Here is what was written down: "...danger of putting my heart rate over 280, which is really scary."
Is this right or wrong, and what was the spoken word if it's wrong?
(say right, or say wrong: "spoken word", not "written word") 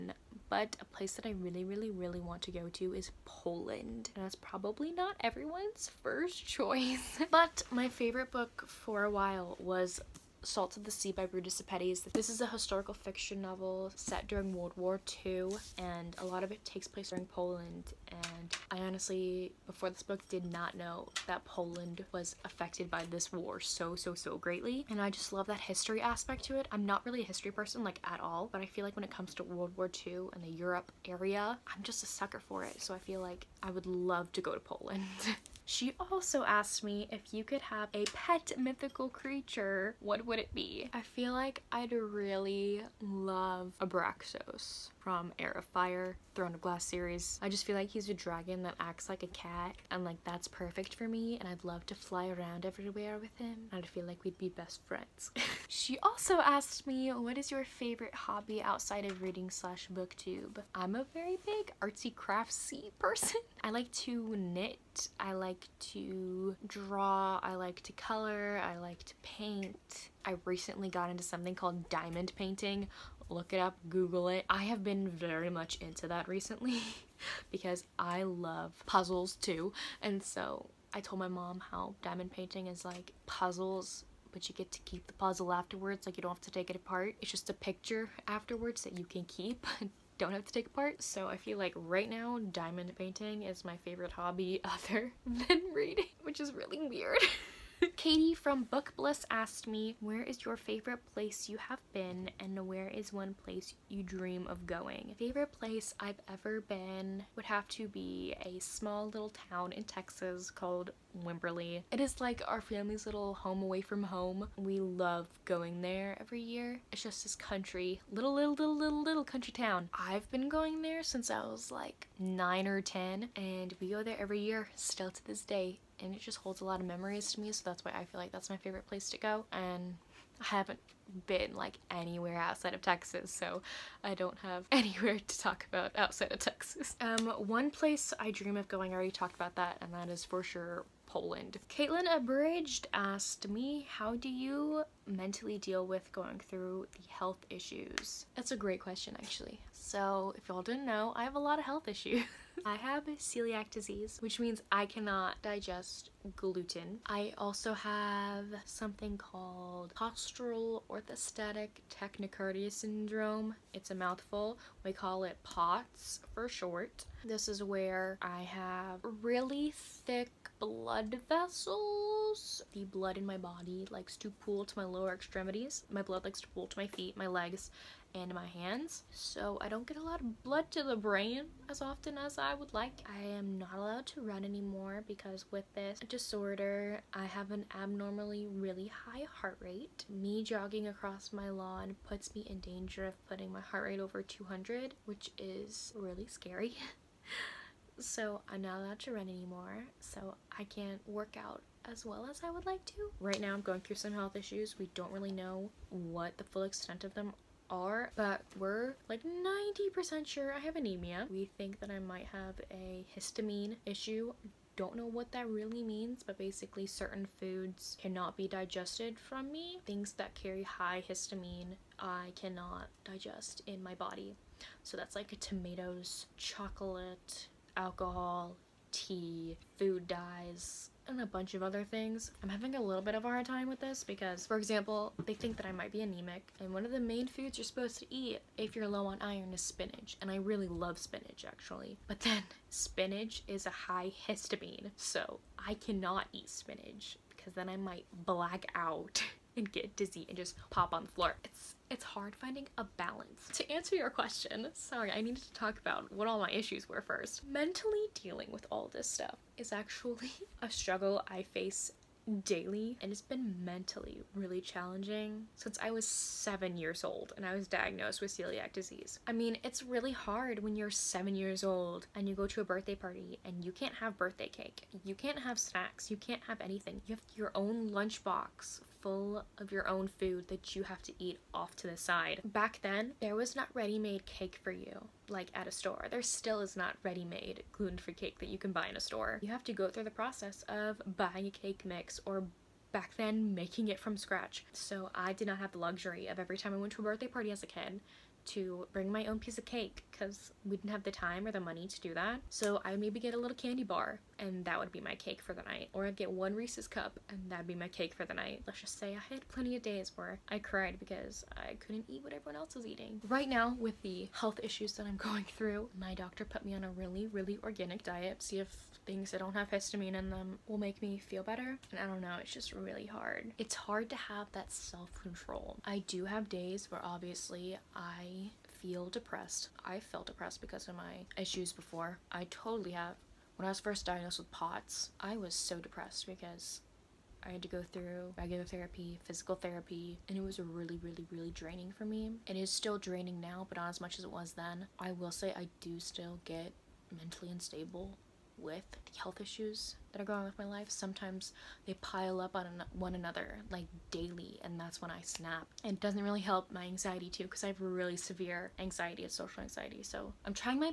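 wrong: "200", not "280".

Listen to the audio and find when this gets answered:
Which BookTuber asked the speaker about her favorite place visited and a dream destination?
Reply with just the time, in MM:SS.
01:37.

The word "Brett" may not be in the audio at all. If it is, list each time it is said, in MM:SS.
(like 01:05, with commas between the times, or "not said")
not said.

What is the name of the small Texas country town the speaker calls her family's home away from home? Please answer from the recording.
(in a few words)
Wimberley.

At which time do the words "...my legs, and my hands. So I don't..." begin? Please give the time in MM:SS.
02:57.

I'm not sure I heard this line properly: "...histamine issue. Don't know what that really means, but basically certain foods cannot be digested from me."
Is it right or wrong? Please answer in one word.
right.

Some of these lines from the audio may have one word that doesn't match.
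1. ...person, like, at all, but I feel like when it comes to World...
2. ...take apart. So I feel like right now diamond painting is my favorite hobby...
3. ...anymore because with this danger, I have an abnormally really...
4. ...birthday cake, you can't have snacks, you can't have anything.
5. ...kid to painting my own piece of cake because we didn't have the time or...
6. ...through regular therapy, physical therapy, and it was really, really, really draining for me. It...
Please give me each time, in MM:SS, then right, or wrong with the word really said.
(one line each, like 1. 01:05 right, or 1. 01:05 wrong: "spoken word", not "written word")
1. 00:27 right
2. 01:30 right
3. 03:04 wrong: "disorder", not "danger"
4. 04:34 right
5. 04:57 wrong: "bring", not "painting"
6. 05:37 right.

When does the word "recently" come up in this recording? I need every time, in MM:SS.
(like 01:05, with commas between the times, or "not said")
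01:10, 01:16.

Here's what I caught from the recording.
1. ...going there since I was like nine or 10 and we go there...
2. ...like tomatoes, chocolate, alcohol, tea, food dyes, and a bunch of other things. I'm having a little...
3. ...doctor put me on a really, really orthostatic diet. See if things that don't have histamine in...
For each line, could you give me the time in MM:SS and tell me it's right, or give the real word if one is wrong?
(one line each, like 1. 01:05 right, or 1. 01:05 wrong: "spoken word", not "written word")
1. 02:00 right
2. 03:45 right
3. 05:16 wrong: "organic", not "orthostatic".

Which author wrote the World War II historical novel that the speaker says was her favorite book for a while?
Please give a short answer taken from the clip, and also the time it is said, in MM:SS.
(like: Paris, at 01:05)
Ruta Sepetys, at 00:11.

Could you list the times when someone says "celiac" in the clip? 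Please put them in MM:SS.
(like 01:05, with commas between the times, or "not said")
02:33, 04:28.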